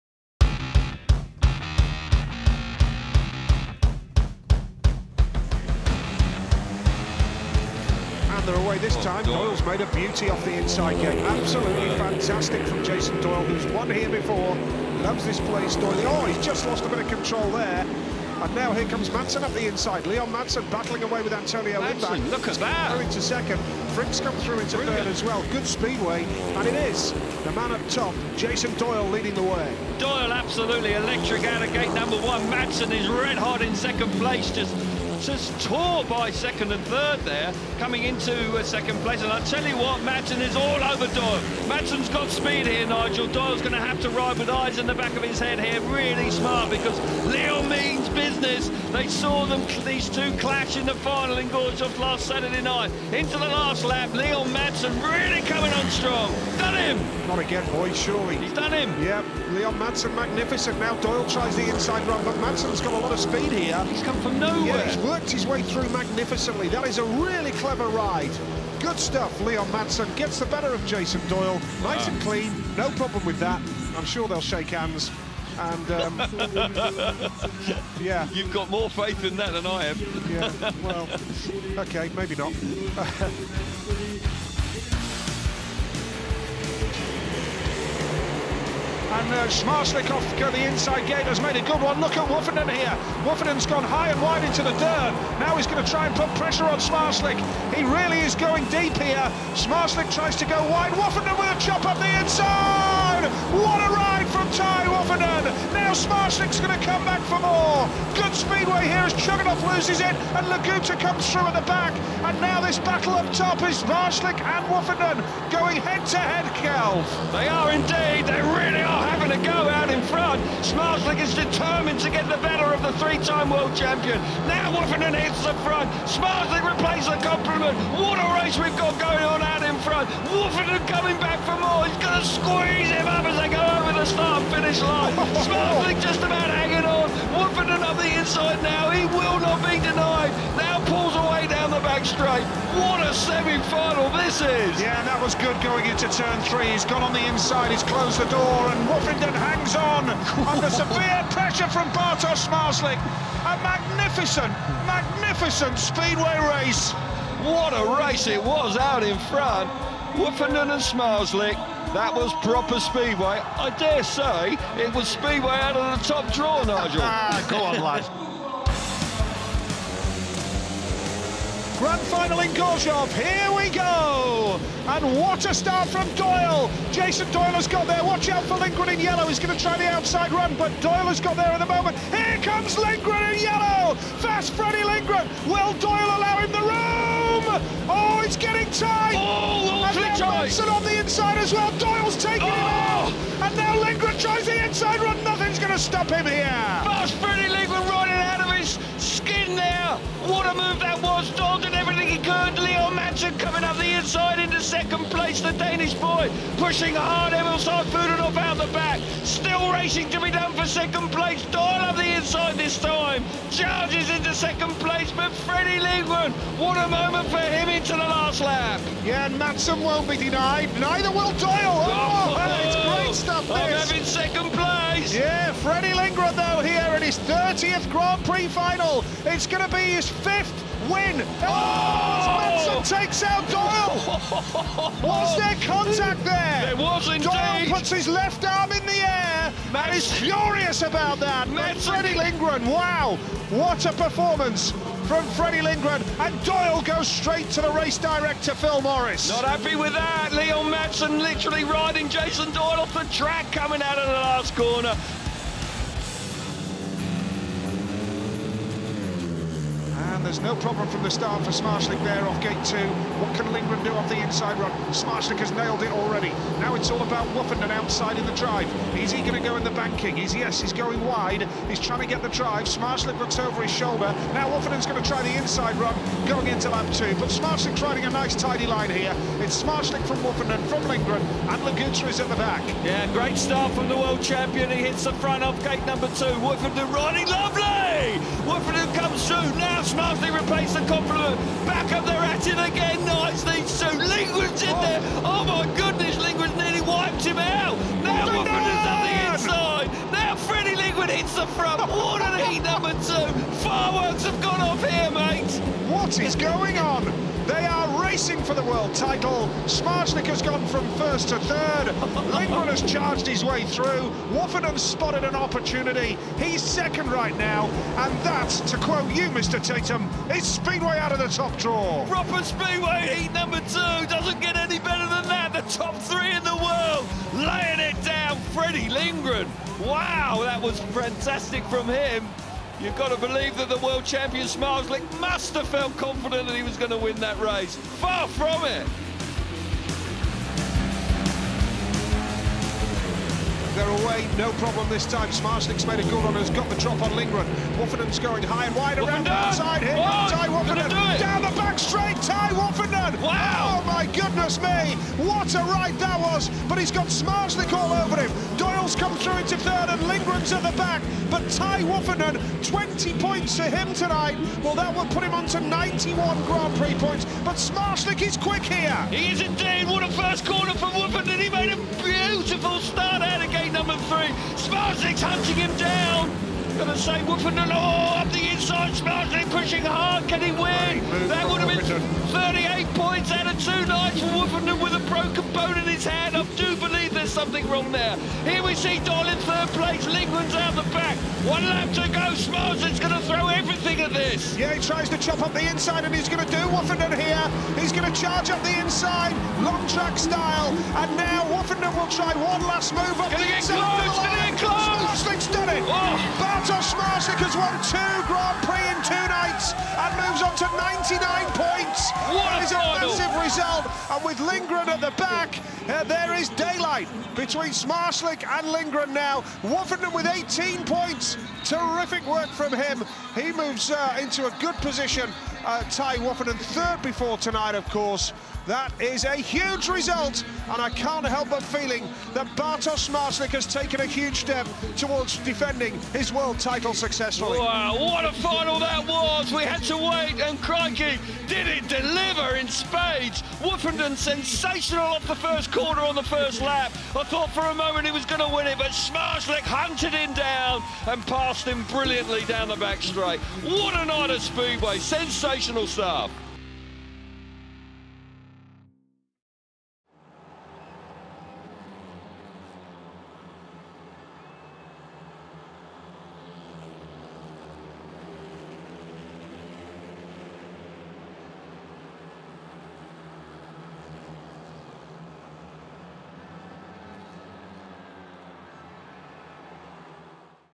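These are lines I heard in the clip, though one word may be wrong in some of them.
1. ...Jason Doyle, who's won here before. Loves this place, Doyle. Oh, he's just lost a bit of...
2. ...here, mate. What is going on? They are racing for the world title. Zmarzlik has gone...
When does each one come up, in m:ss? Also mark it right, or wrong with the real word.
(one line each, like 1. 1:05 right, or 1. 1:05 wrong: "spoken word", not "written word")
1. 0:12 right
2. 5:04 right.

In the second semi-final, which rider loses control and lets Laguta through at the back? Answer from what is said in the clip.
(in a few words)
Chugunov.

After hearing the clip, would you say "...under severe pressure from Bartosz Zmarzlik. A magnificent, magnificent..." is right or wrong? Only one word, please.
right.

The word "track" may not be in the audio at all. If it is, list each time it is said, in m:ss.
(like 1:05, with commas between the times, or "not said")
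4:13, 6:39.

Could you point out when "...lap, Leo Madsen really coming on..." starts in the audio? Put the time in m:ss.
0:53.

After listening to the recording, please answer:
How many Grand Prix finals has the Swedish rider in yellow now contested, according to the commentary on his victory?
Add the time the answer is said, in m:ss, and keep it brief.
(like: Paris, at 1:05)
30, at 3:47.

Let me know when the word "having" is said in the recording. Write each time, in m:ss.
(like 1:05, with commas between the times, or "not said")
1:59, 3:43.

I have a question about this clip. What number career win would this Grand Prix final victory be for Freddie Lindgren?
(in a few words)
5th.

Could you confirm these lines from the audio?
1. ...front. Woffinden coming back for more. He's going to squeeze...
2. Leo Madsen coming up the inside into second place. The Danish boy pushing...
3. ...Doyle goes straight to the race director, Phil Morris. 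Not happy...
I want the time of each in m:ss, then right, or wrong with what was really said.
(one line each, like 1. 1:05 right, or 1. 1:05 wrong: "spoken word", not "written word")
1. 2:09 right
2. 3:22 right
3. 4:06 right.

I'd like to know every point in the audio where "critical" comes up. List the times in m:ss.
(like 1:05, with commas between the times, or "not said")
not said.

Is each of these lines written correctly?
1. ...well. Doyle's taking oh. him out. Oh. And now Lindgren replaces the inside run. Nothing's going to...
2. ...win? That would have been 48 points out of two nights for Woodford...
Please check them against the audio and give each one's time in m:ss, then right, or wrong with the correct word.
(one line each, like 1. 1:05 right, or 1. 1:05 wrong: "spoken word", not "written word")
1. 3:11 wrong: "tries", not "replaces"
2. 6:20 wrong: "38", not "48".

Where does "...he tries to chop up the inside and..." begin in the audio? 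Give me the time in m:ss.
6:34.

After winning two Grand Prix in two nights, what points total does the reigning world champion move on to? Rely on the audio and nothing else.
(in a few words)
99.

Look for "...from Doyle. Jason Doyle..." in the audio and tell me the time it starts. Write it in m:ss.
2:55.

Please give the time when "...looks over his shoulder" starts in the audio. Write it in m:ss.
4:33.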